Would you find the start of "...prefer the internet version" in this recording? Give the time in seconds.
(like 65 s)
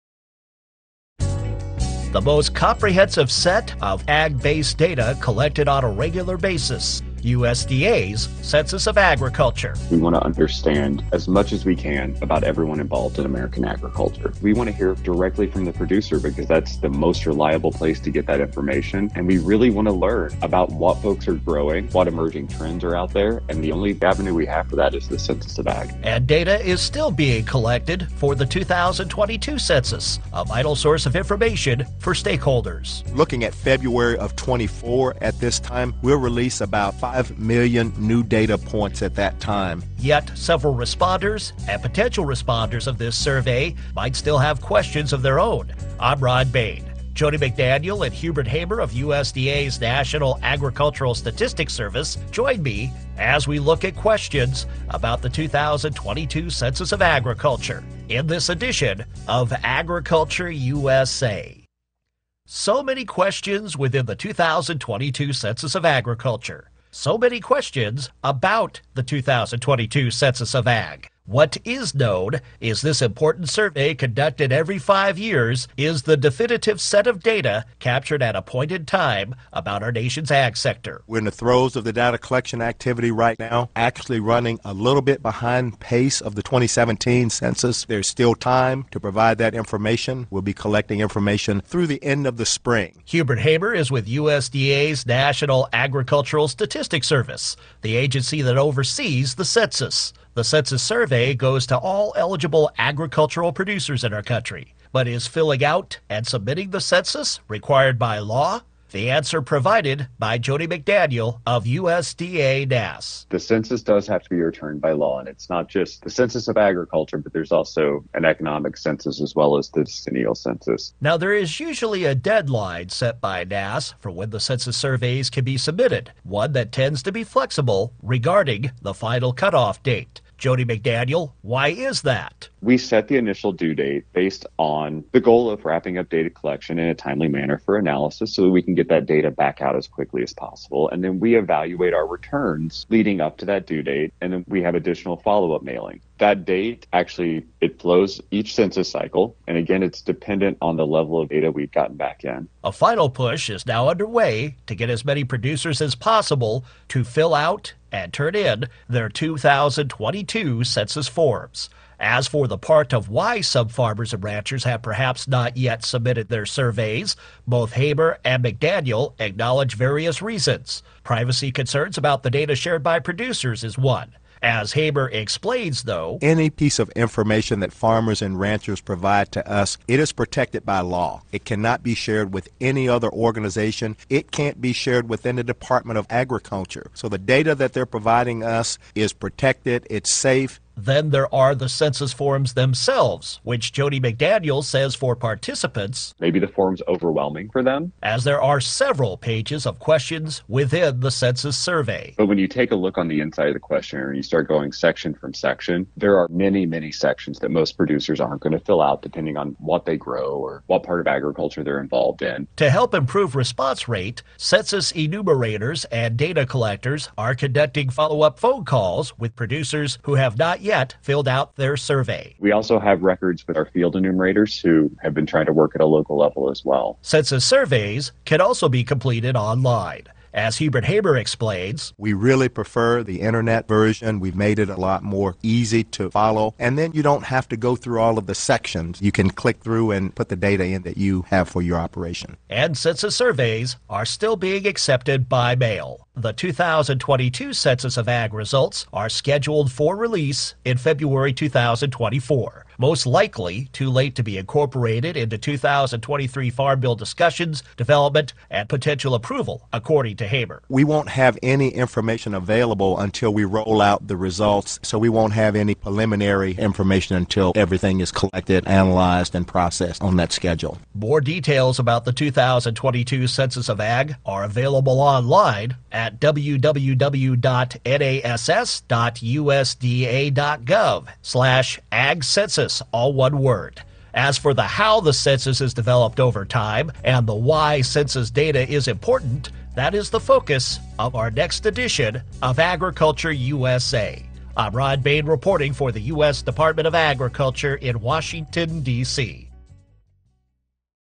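232 s.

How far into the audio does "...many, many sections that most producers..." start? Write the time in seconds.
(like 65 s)
206 s.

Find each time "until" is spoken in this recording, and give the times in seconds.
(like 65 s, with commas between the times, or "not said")
262 s, 267 s.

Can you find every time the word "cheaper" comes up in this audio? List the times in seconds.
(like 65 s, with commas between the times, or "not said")
not said.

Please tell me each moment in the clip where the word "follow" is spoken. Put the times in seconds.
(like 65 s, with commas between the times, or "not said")
145 s, 217 s, 236 s.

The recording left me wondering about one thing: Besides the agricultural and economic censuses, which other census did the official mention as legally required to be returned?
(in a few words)
decennial census.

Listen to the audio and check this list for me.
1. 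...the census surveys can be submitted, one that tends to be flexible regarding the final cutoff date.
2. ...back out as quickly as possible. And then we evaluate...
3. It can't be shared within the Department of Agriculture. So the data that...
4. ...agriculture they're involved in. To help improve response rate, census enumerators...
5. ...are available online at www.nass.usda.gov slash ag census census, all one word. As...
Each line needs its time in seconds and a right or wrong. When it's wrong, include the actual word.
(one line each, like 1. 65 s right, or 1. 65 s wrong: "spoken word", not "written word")
1. 124 s right
2. 139 s right
3. 184 s right
4. 211 s right
5. 274 s right.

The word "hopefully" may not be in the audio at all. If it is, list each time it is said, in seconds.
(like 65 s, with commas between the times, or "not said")
not said.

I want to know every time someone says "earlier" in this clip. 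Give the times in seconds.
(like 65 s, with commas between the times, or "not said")
not said.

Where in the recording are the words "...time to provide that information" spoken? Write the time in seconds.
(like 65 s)
88 s.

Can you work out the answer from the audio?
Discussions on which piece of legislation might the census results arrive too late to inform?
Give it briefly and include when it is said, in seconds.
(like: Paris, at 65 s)
2023 Farm Bill, at 255 s.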